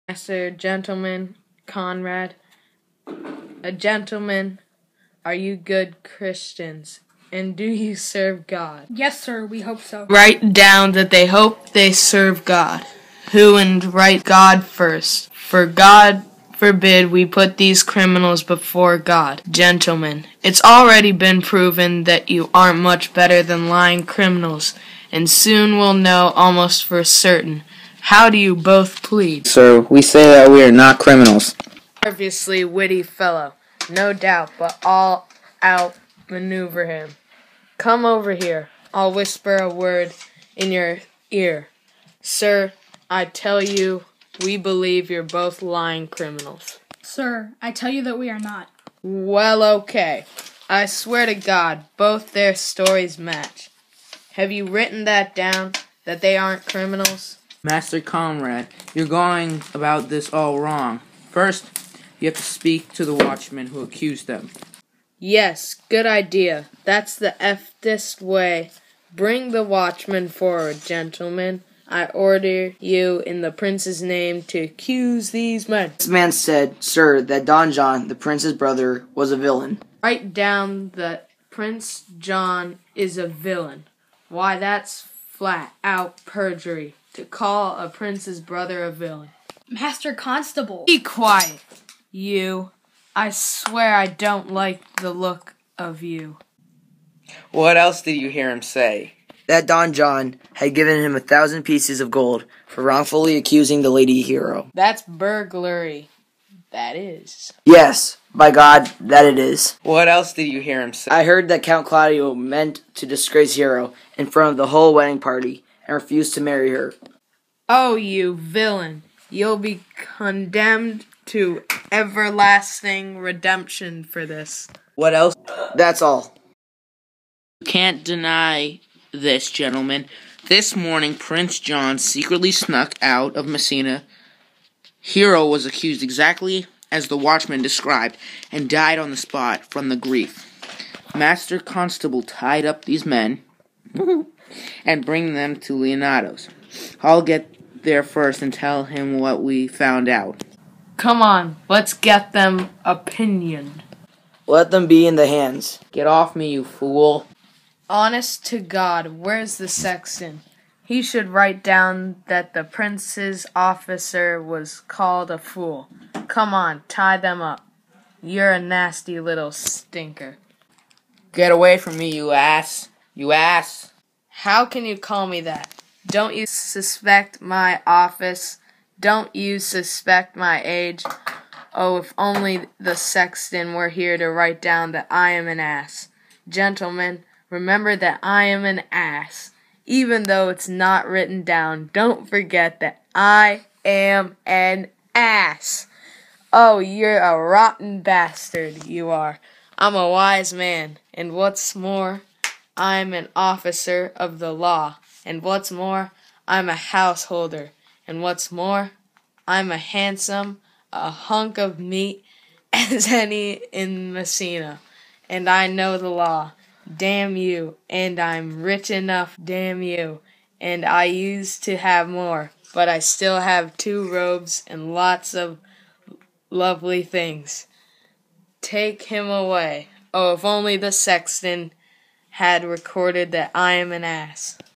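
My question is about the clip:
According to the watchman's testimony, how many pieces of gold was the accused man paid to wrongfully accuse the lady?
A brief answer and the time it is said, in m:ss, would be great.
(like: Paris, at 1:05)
1000, at 1:41.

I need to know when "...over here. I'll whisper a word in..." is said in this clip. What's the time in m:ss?
0:38.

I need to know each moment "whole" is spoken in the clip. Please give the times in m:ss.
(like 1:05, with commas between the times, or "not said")
1:54.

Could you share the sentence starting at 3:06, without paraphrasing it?
Gentlemen, remember that I am an ass.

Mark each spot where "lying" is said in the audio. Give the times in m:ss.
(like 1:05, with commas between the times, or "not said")
0:23, 0:45.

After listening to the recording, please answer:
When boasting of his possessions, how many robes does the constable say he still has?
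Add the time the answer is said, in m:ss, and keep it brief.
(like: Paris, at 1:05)
2, at 3:43.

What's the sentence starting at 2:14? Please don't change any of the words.
Hero was accused exactly as the watchman described and died on the spot from the grief.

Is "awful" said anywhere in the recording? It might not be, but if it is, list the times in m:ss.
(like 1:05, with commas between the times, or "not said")
not said.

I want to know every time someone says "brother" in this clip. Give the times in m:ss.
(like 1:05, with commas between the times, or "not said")
1:18, 1:28.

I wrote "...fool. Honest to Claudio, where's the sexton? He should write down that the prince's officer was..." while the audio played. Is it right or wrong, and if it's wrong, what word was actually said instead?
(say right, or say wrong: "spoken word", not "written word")
wrong: "God", not "Claudio".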